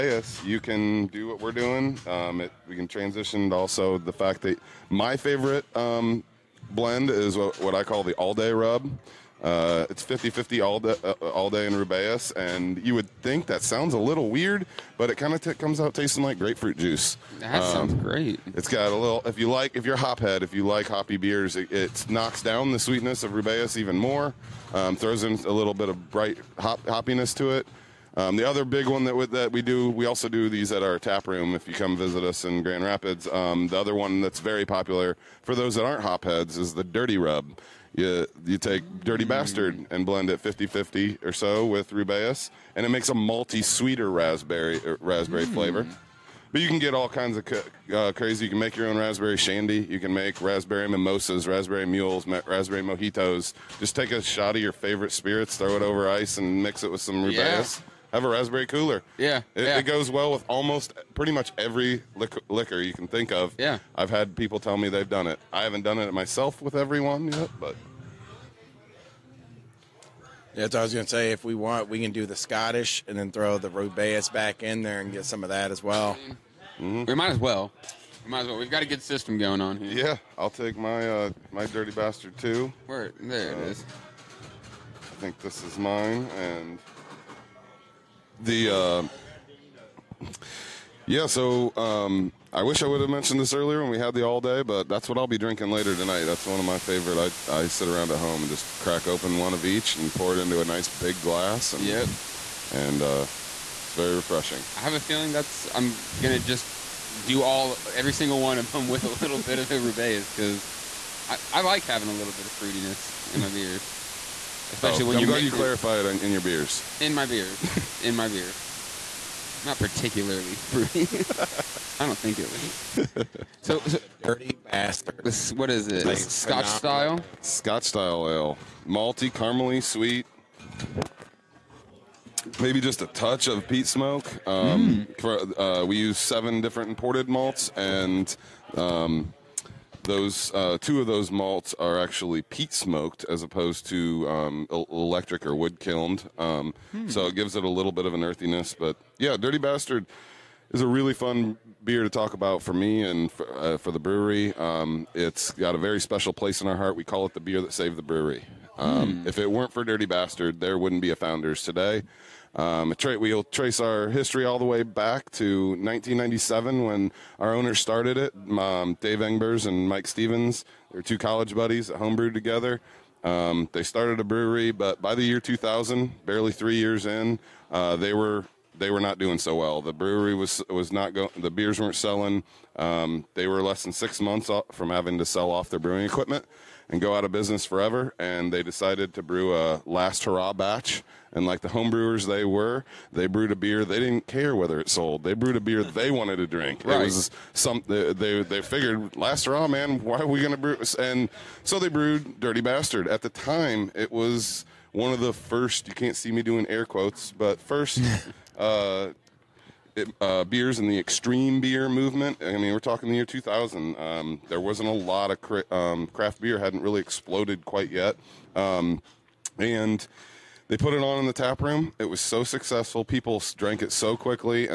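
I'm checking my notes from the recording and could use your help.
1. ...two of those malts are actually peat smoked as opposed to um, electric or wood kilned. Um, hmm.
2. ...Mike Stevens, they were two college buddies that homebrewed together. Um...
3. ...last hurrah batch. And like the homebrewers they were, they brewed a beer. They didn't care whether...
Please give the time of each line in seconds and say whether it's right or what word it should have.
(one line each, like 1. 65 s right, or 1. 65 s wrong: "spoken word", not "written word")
1. 140 s right
2. 169 s right
3. 189 s right.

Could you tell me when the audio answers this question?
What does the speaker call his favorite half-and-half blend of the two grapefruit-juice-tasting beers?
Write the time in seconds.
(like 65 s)
8 s.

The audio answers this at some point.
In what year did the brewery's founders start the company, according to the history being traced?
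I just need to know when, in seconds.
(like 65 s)
165 s.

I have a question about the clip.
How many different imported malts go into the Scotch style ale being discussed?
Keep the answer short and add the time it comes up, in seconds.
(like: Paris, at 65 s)
7, at 136 s.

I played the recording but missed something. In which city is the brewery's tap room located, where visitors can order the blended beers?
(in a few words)
Grand Rapids.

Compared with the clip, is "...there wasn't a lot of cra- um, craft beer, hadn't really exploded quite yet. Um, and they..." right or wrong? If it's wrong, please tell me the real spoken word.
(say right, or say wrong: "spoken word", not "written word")
right.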